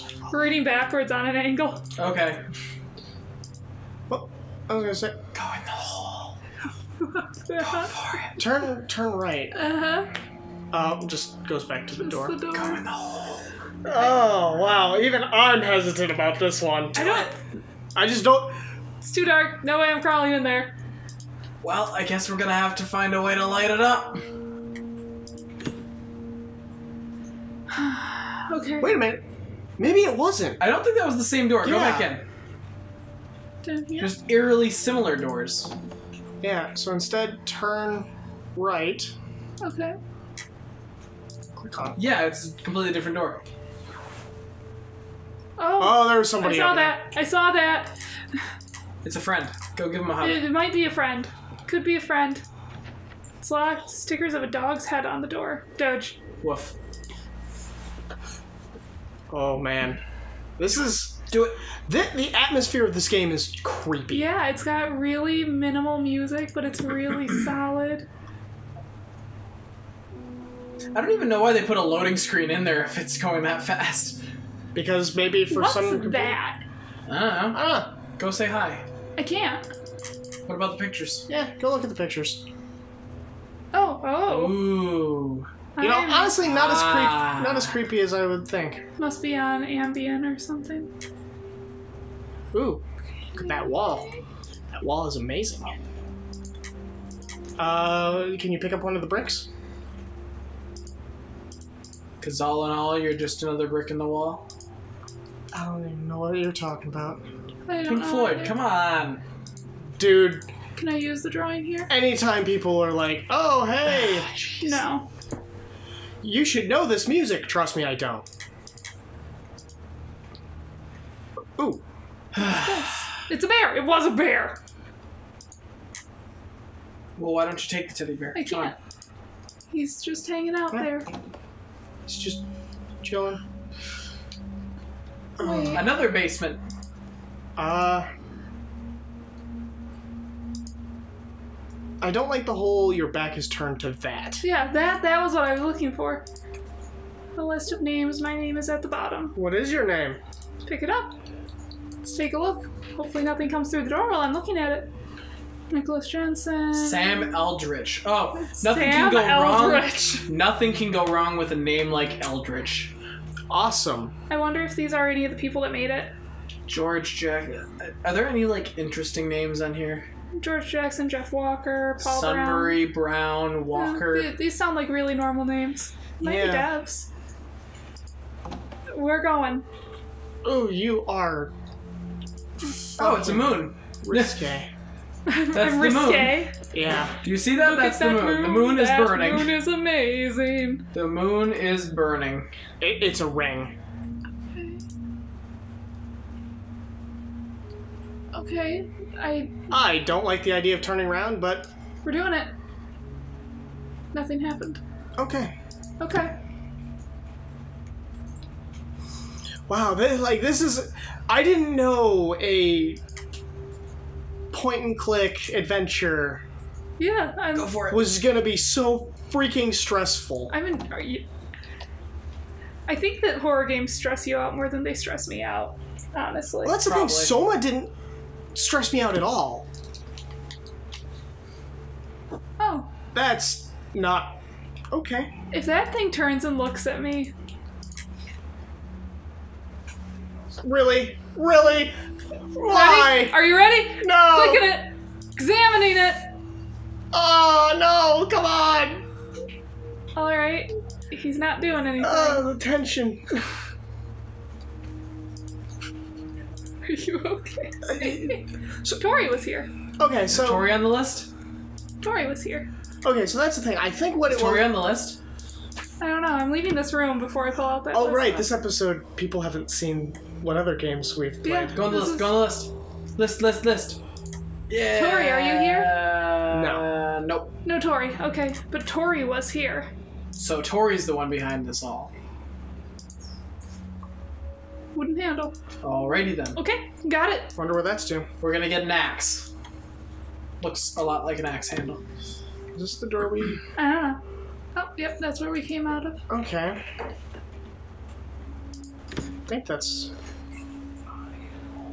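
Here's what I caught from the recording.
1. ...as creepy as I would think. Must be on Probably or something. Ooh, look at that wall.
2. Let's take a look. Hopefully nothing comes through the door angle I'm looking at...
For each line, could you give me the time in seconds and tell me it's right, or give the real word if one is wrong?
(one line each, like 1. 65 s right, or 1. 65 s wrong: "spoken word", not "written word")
1. 87 s wrong: "Ambien", not "Probably"
2. 151 s wrong: "while", not "angle".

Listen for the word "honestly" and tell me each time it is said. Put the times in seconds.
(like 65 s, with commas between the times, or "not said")
86 s, 226 s.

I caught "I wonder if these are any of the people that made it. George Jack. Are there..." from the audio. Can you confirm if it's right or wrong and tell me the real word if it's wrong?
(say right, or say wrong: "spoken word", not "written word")
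right.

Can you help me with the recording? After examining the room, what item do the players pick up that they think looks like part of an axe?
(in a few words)
Wooden handle.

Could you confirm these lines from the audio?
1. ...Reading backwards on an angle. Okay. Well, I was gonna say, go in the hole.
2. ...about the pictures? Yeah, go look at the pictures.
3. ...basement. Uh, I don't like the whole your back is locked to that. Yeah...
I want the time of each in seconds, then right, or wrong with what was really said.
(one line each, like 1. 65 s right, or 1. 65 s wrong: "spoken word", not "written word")
1. 0 s right
2. 80 s right
3. 136 s wrong: "turned", not "locked".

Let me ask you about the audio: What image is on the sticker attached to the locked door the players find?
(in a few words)
A dog's head.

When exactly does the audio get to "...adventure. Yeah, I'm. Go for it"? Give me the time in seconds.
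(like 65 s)
215 s.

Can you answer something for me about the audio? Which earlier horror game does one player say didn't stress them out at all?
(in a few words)
Soma.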